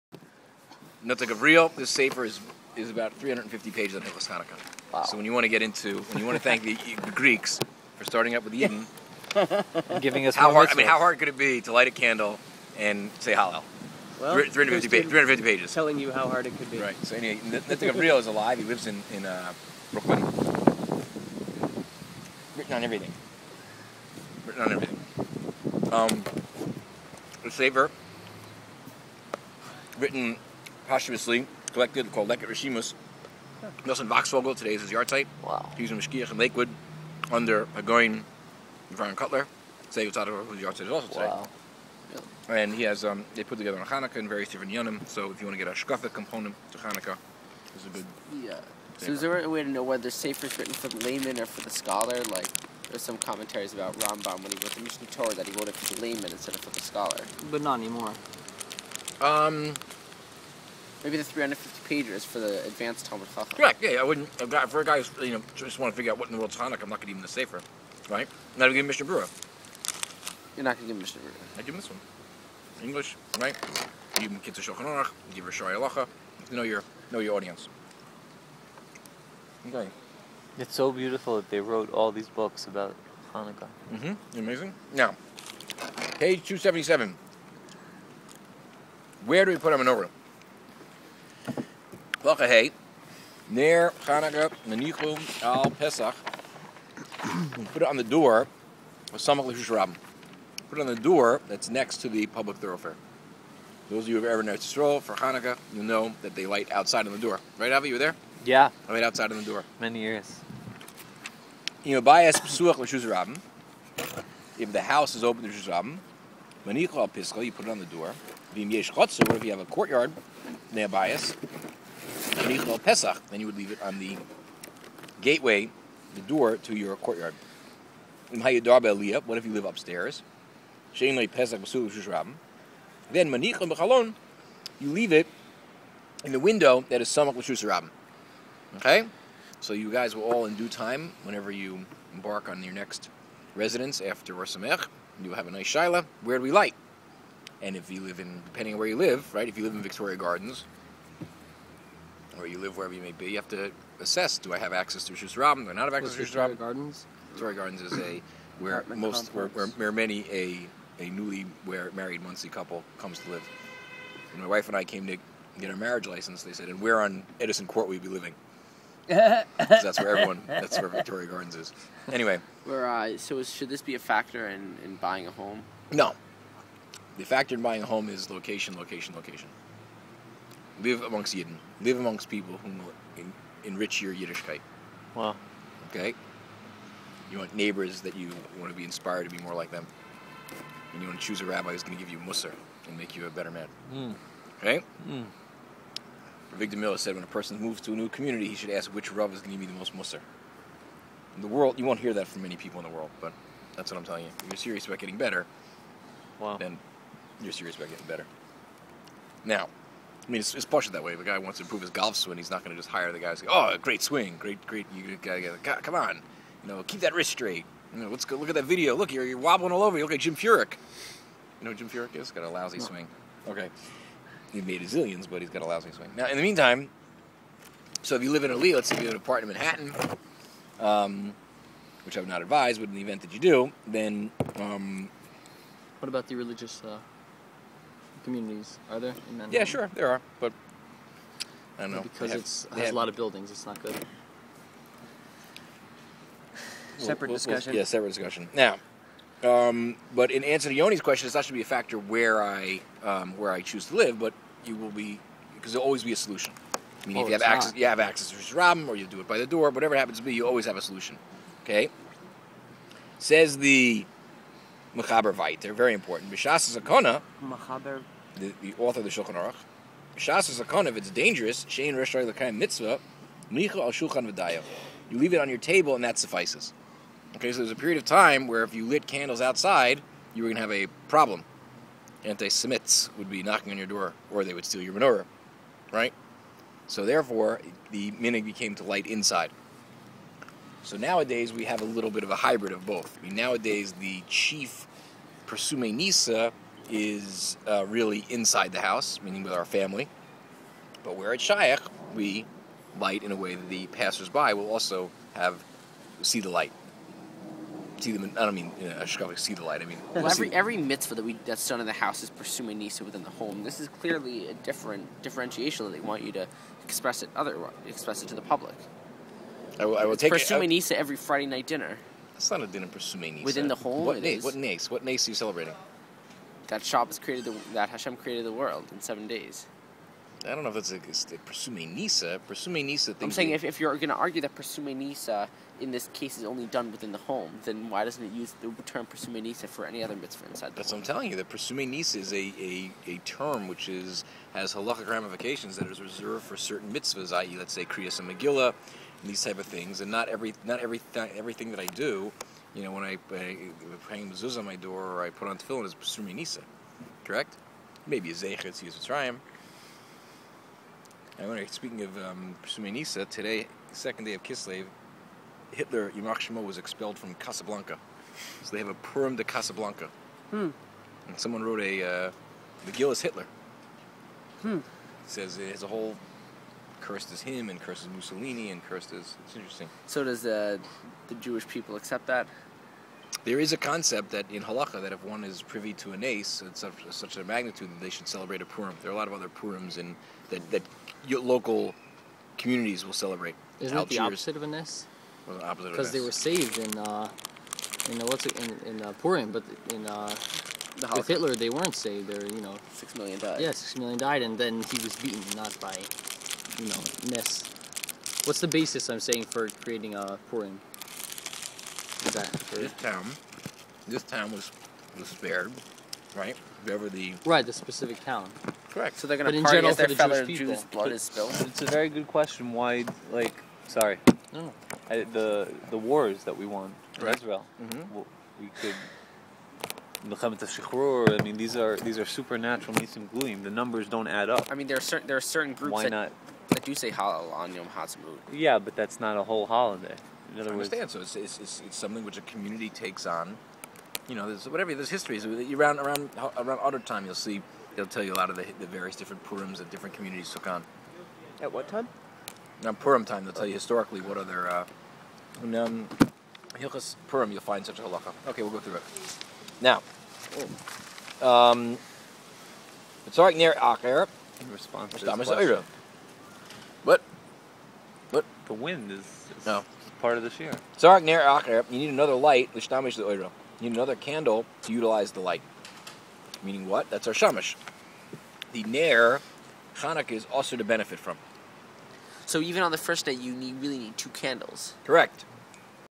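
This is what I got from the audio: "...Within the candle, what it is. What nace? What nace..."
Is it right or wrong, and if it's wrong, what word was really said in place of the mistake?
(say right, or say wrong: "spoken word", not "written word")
wrong: "whole", not "candle".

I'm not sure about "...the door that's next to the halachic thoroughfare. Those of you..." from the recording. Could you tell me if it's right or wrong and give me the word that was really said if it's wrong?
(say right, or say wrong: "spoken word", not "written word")
wrong: "public", not "halachic".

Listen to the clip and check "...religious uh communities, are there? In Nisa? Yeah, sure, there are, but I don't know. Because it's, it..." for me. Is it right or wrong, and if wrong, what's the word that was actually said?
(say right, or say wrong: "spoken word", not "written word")
wrong: "Manhattan", not "Nisa".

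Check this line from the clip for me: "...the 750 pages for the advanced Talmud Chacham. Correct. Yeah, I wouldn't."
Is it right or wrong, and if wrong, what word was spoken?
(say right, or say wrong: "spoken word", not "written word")
wrong: "350", not "750".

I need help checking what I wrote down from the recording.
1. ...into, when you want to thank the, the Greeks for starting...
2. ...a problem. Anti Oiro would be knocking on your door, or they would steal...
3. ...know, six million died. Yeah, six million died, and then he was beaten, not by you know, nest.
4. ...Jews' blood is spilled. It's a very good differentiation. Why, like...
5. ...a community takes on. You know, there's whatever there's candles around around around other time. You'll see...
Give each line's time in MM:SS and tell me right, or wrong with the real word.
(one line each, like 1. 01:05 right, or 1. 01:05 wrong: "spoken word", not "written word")
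1. 00:05 right
2. 04:40 wrong: "Semites", not "Oiro"
3. 06:42 right
4. 07:00 wrong: "question", not "differentiation"
5. 07:22 wrong: "histories", not "candles".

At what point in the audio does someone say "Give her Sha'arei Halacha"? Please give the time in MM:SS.
01:15.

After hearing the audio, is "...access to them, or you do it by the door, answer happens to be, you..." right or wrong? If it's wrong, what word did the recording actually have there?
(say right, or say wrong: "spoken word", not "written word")
wrong: "whatever", not "answer".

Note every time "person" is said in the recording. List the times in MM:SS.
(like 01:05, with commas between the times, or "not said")
03:17.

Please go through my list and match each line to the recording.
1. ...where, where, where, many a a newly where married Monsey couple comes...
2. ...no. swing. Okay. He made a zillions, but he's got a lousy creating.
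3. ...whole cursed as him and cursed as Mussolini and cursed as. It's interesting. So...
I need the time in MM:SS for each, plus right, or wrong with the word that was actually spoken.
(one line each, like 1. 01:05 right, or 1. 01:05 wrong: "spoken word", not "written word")
1. 02:39 right
2. 03:42 wrong: "swing", not "creating"
3. 06:15 right.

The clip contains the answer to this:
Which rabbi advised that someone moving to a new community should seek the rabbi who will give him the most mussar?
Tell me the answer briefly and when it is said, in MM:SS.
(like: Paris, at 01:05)
Avigdor Miller, at 03:16.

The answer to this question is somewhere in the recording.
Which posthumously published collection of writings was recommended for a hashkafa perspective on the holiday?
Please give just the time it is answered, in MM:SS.
00:32.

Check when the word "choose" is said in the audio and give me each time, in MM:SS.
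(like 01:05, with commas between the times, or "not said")
03:11, 04:13.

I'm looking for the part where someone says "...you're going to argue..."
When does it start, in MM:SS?
05:33.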